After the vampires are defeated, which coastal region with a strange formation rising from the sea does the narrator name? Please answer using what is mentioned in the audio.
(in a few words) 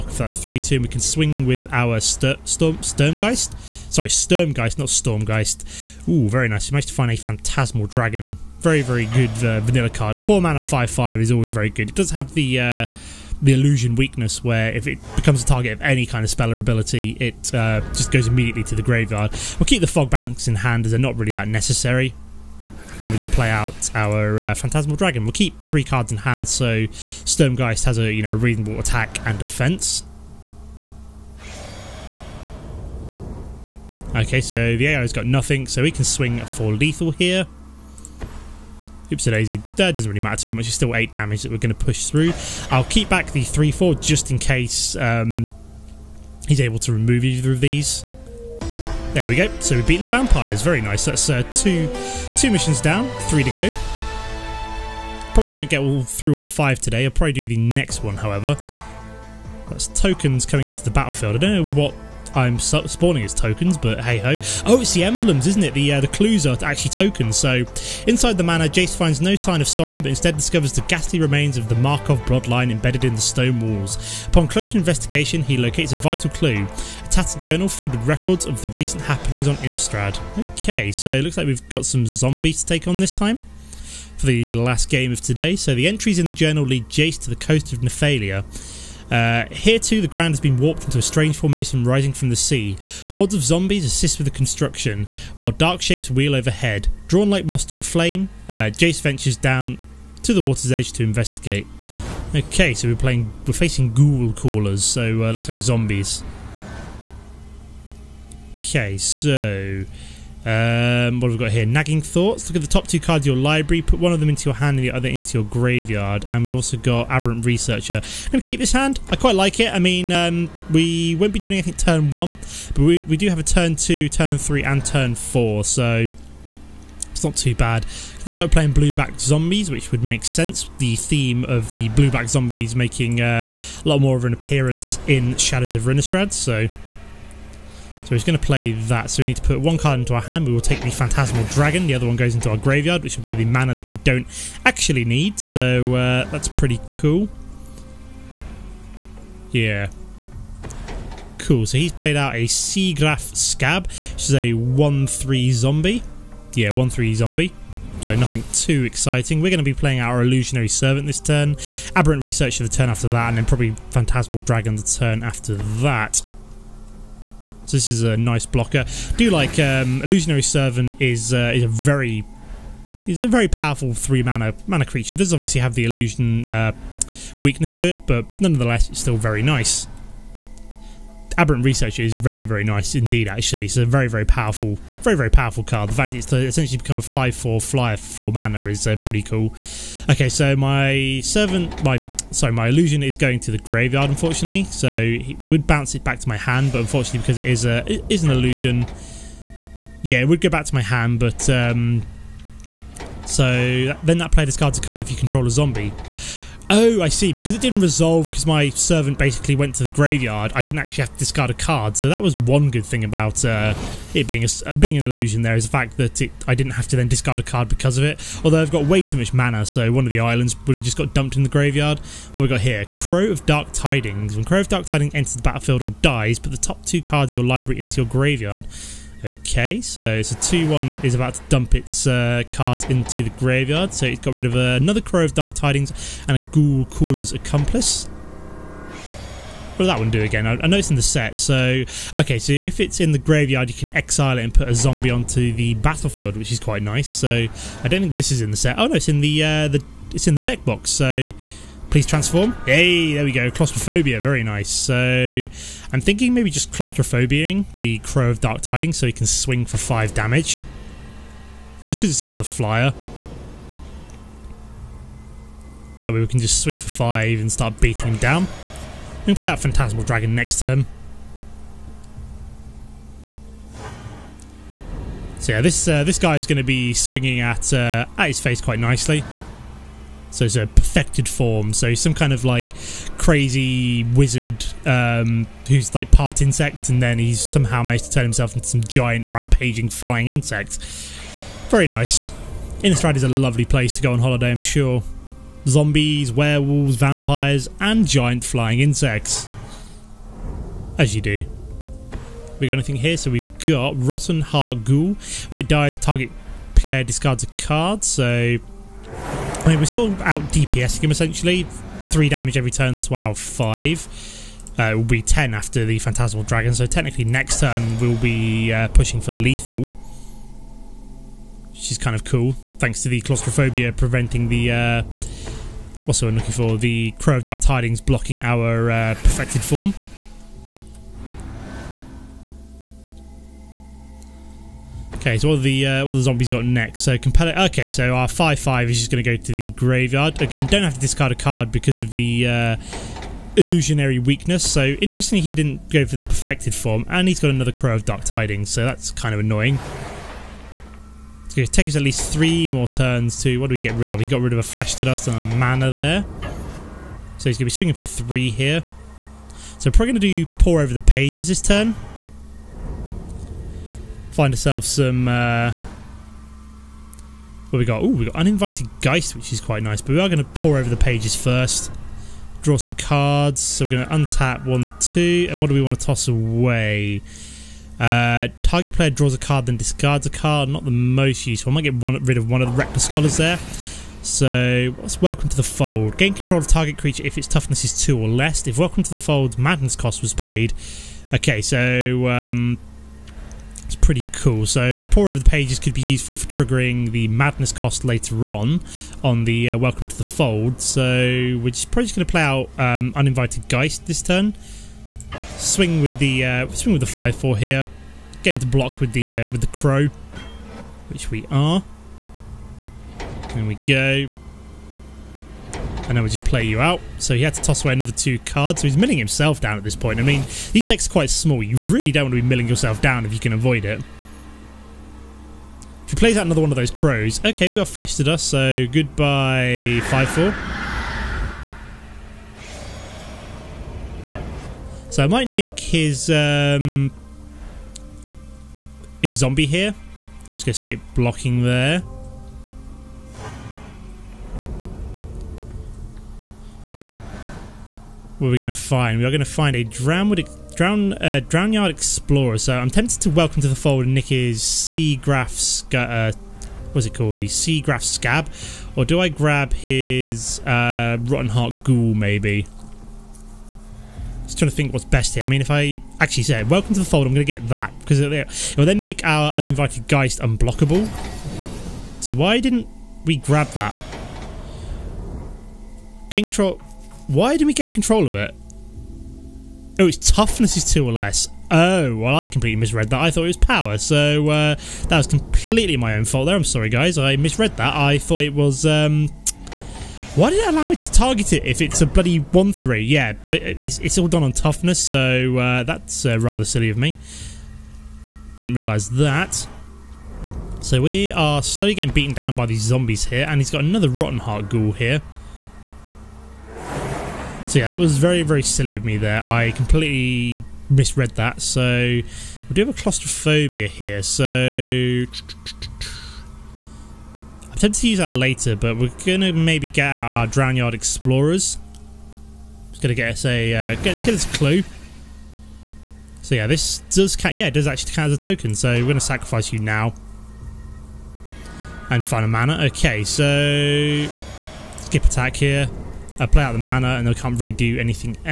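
Nephalia.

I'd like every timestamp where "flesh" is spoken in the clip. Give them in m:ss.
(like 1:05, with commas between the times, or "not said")
5:54, 7:07.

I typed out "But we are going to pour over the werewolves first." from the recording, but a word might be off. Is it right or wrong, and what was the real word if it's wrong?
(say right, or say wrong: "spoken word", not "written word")
wrong: "pages", not "werewolves".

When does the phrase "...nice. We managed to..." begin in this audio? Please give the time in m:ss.
0:06.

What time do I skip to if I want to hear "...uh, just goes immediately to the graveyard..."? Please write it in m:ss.
0:17.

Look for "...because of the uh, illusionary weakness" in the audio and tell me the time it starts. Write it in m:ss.
5:41.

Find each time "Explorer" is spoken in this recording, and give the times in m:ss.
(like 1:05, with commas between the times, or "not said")
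7:31, 8:40.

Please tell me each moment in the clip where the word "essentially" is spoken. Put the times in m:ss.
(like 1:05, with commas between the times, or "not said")
3:06, 5:11.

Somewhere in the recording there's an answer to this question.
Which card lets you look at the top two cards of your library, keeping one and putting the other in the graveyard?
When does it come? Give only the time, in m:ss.
1:51.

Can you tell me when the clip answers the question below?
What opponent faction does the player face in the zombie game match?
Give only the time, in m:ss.
1:43.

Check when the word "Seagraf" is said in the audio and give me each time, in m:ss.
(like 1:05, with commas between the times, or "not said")
2:32, 7:37.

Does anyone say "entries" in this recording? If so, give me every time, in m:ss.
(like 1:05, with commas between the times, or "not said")
1:25.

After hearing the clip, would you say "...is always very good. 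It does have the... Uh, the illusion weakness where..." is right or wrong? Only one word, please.
right.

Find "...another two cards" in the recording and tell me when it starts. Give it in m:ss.
6:57.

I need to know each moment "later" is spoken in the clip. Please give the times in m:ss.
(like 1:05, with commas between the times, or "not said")
6:38, 8:38.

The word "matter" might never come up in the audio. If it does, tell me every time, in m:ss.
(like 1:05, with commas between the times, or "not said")
0:40.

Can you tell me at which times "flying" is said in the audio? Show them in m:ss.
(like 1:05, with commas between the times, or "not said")
4:49, 4:58.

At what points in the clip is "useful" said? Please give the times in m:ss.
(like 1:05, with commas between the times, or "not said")
6:21, 6:36.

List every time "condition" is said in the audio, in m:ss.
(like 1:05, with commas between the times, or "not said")
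not said.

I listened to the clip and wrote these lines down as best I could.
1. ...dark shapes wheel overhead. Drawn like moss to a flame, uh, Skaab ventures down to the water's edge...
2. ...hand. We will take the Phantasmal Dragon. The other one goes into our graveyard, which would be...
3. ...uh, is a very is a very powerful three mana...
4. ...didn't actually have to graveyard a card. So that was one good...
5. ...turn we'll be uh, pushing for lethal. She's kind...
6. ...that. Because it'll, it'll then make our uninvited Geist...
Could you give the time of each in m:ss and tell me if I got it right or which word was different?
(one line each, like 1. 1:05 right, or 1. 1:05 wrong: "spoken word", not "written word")
1. 1:35 wrong: "Jace", not "Skaab"
2. 2:20 right
3. 2:51 right
4. 3:30 wrong: "discard", not "graveyard"
5. 5:17 right
6. 7:47 right.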